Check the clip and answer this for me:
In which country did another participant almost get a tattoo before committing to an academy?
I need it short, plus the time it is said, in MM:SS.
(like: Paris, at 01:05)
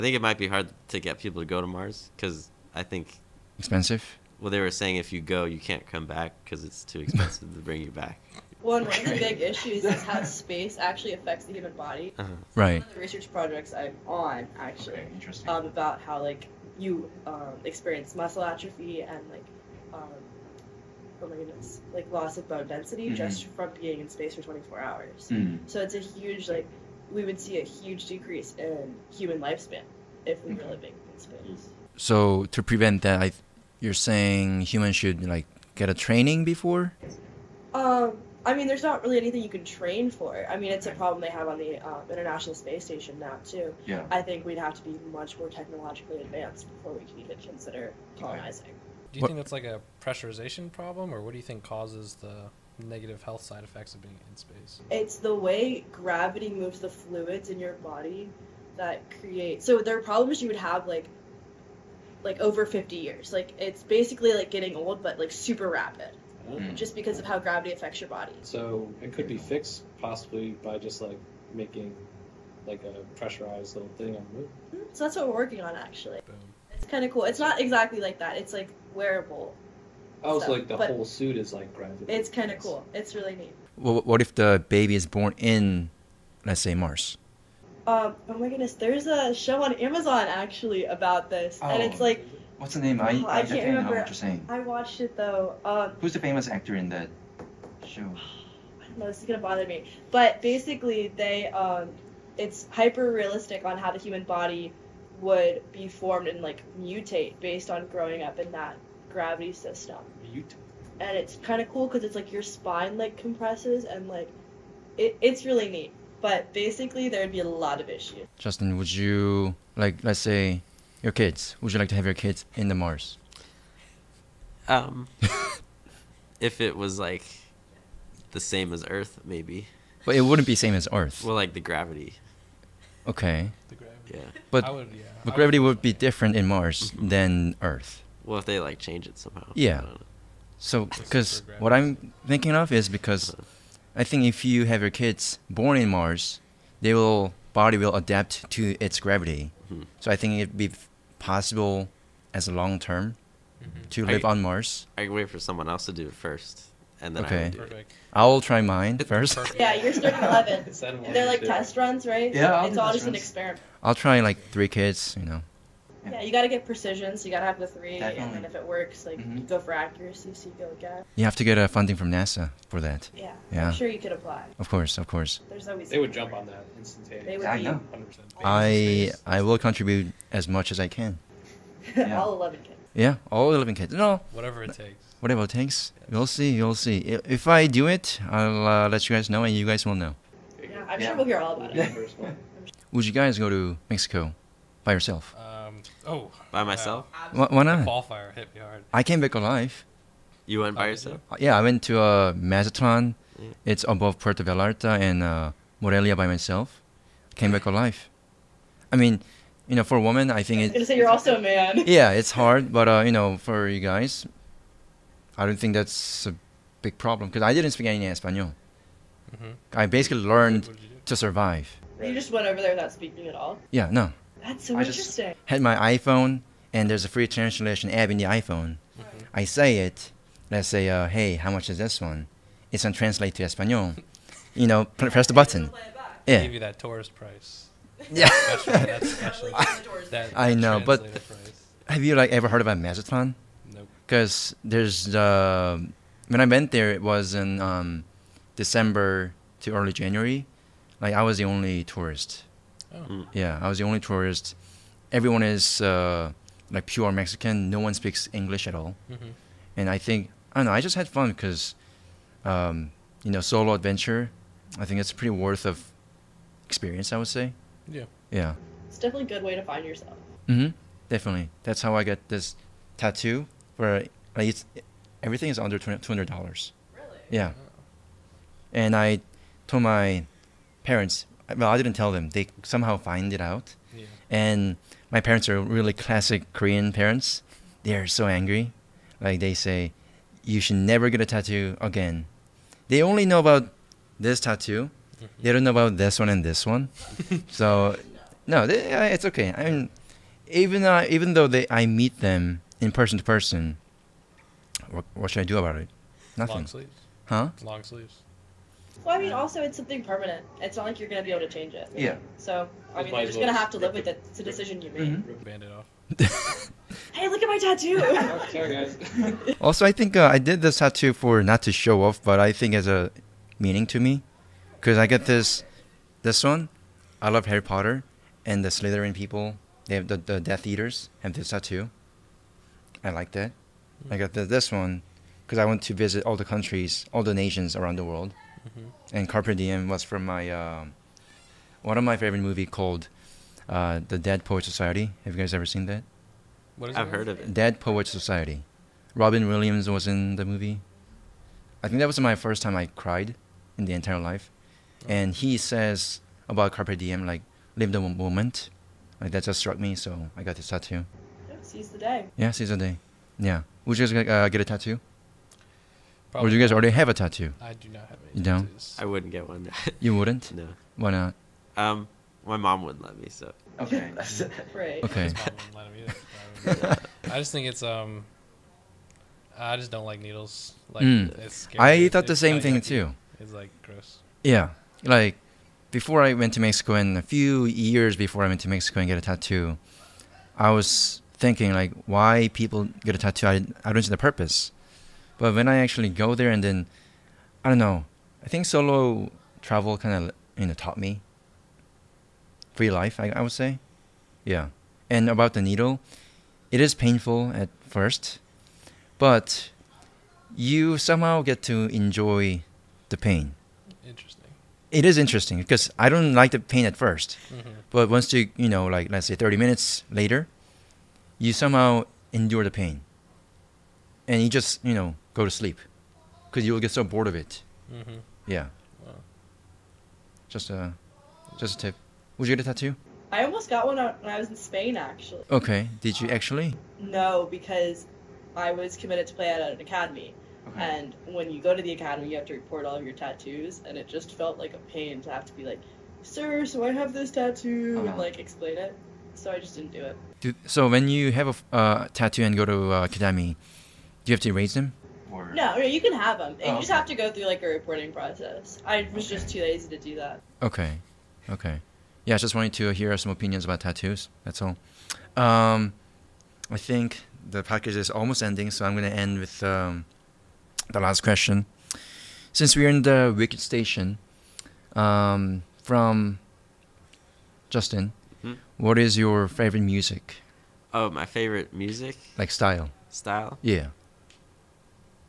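Spain, at 07:14.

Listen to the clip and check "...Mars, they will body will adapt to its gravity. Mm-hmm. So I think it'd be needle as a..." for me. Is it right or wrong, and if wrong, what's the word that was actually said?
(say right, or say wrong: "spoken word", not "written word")
wrong: "possible", not "needle".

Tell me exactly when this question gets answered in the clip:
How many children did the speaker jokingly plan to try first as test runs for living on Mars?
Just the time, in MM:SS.
02:44.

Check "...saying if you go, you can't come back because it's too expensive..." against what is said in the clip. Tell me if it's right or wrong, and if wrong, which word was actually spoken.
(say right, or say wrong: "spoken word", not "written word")
right.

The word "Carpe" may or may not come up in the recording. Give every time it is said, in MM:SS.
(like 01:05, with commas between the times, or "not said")
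05:39, 05:56.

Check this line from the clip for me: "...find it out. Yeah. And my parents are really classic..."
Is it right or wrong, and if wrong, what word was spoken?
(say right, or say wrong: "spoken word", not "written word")
right.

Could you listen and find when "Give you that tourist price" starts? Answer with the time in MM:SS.
03:56.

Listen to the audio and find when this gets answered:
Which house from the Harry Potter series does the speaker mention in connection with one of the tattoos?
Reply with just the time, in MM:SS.
05:28.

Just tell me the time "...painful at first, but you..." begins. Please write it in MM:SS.
06:46.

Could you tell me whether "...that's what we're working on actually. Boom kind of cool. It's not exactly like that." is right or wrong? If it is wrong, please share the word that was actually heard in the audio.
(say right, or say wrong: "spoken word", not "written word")
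right.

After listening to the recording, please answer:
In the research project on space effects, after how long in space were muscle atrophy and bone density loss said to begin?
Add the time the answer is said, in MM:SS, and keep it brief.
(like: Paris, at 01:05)
24 hours, at 00:24.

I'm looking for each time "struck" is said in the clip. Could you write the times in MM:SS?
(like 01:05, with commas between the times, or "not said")
05:59.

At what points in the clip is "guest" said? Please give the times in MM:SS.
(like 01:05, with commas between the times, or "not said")
not said.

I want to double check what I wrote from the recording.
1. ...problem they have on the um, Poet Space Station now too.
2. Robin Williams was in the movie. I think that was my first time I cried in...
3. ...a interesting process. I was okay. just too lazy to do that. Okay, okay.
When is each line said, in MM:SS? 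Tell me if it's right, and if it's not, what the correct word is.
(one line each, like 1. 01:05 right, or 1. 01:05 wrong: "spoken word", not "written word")
1. 00:40 wrong: "International", not "Poet"
2. 05:49 right
3. 07:37 wrong: "reporting", not "interesting".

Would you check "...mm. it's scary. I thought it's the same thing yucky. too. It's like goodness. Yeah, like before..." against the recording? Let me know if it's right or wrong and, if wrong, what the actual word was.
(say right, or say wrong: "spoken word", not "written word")
wrong: "gross", not "goodness".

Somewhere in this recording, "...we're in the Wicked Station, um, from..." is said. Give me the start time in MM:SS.
07:52.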